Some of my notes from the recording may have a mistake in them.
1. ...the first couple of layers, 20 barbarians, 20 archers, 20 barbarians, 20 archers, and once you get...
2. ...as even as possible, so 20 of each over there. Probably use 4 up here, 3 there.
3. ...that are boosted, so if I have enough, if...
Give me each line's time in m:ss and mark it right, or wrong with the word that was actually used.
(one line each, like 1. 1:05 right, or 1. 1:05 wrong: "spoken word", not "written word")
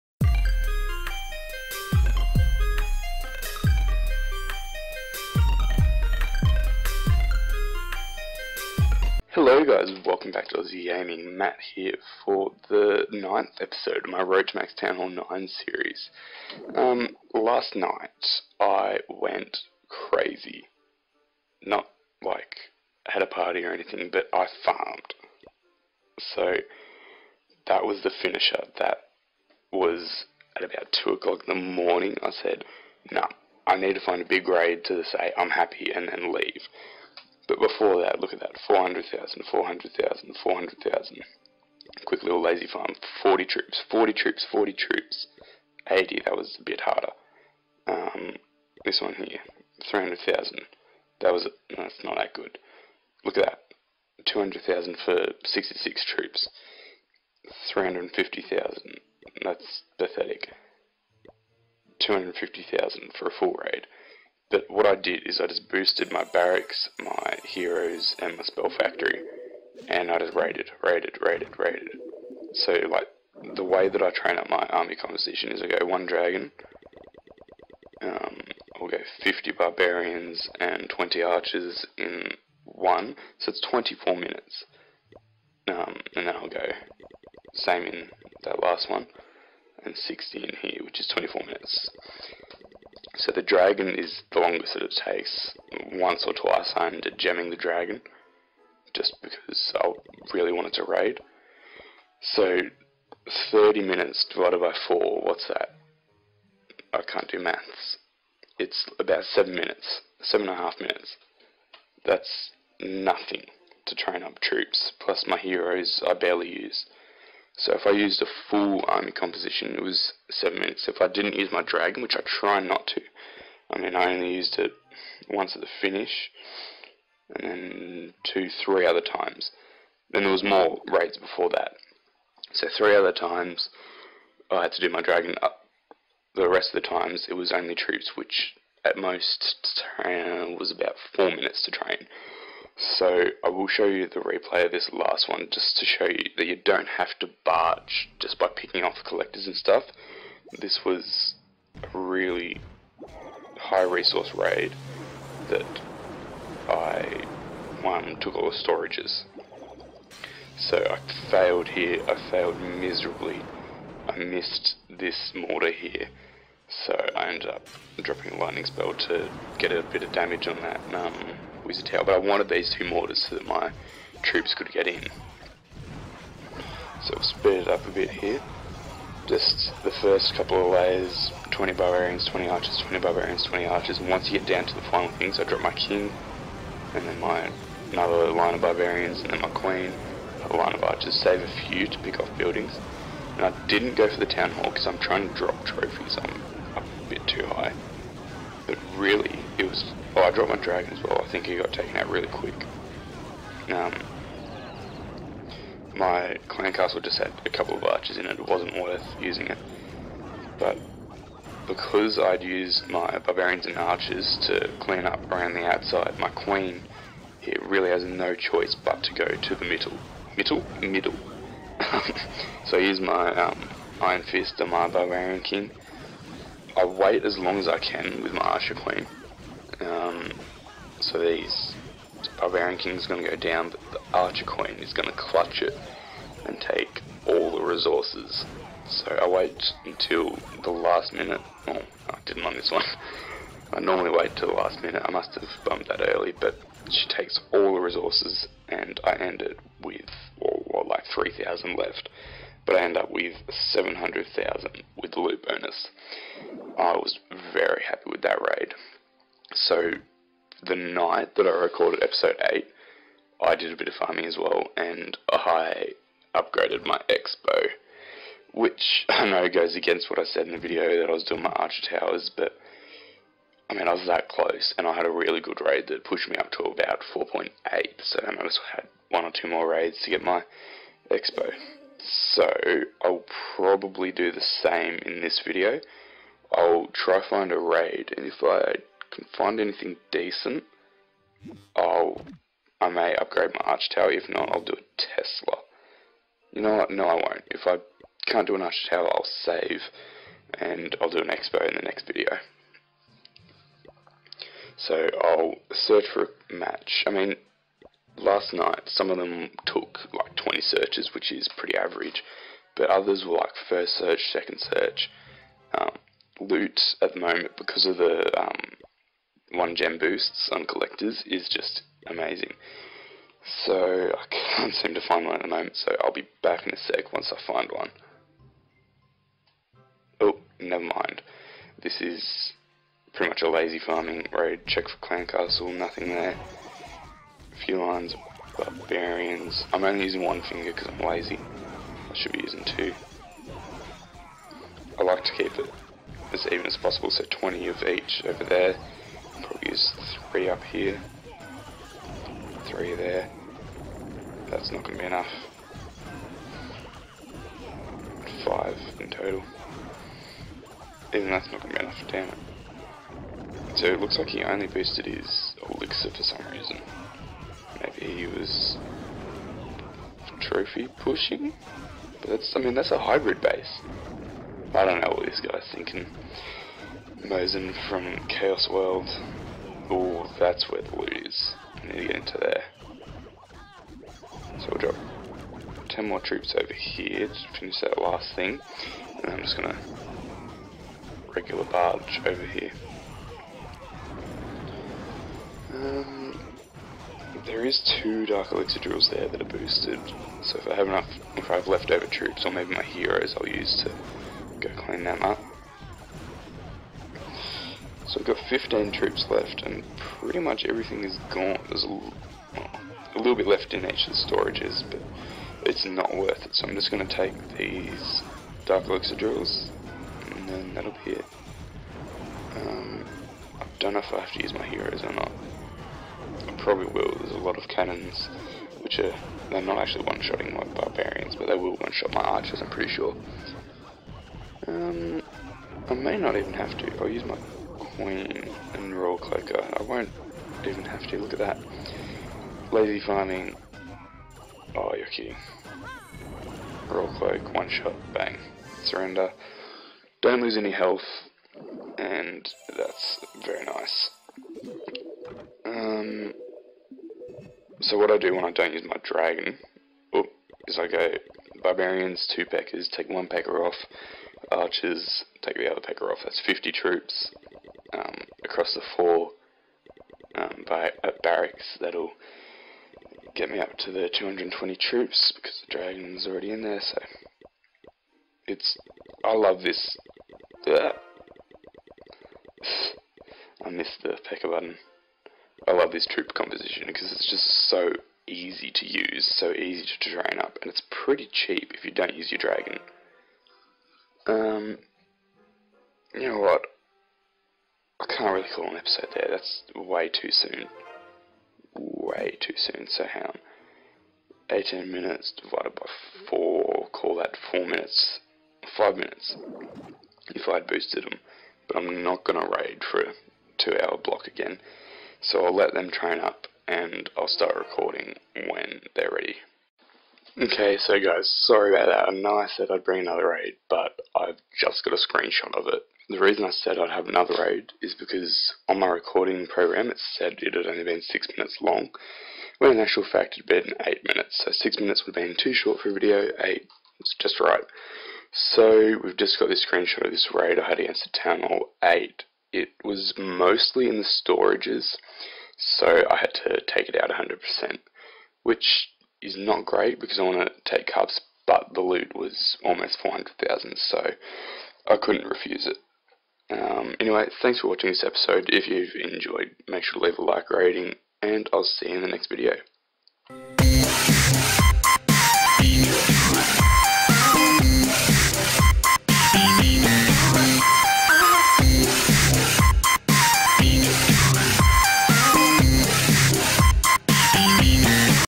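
1. 2:59 right
2. 5:46 wrong: "3", not "4"
3. 6:39 right.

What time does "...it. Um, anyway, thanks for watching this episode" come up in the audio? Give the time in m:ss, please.
9:15.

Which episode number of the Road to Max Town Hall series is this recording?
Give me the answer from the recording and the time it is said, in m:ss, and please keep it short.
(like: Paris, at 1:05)
9th, at 0:13.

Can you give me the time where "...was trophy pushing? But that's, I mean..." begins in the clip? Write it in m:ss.
6:08.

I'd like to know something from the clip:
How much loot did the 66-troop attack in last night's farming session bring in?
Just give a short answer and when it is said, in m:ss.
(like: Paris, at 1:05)
200,000, at 0:54.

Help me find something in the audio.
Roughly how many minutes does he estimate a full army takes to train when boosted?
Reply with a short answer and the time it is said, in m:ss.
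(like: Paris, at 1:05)
7.5 minutes, at 1:50.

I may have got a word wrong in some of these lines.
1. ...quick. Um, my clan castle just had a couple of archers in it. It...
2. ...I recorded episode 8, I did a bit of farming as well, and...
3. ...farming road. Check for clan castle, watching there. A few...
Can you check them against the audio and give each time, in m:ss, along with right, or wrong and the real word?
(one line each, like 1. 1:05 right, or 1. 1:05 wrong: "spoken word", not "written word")
1. 3:22 right
2. 4:21 right
3. 5:33 wrong: "nothing", not "watching".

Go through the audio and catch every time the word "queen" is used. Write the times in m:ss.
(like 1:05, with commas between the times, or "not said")
3:09, 3:36, 3:48, 3:54, 7:17.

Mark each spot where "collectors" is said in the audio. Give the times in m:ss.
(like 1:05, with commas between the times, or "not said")
2:29, 5:20.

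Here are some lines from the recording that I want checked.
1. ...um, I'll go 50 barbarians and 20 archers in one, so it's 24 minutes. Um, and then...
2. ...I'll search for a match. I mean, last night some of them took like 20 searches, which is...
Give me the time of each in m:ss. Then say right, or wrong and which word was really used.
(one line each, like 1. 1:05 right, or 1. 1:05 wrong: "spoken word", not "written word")
1. 1:18 right
2. 5:05 right.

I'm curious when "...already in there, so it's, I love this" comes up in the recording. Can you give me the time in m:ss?
7:56.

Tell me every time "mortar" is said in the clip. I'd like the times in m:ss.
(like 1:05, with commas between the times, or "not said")
2:45, 2:52.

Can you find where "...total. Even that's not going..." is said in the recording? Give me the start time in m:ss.
5:59.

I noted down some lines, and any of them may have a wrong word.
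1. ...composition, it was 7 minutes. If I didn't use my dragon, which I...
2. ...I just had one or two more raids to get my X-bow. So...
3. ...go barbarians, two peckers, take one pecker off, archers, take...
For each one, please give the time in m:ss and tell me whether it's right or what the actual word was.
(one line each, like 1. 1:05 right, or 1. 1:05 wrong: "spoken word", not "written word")
1. 1:59 right
2. 4:38 right
3. 7:40 right.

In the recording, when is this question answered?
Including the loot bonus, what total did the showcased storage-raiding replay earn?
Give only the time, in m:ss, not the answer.
4:13.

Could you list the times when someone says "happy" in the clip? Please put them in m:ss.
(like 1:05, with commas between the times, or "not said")
0:35, 4:17.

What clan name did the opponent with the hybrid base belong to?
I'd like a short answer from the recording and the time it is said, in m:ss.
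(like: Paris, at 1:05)
Chaos World, at 6:18.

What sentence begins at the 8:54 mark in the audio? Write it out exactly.
So 6 minutes would have been too short for a video, 8 it's just right.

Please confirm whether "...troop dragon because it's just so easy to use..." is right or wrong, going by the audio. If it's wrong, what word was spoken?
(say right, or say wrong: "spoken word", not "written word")
wrong: "composition", not "dragon".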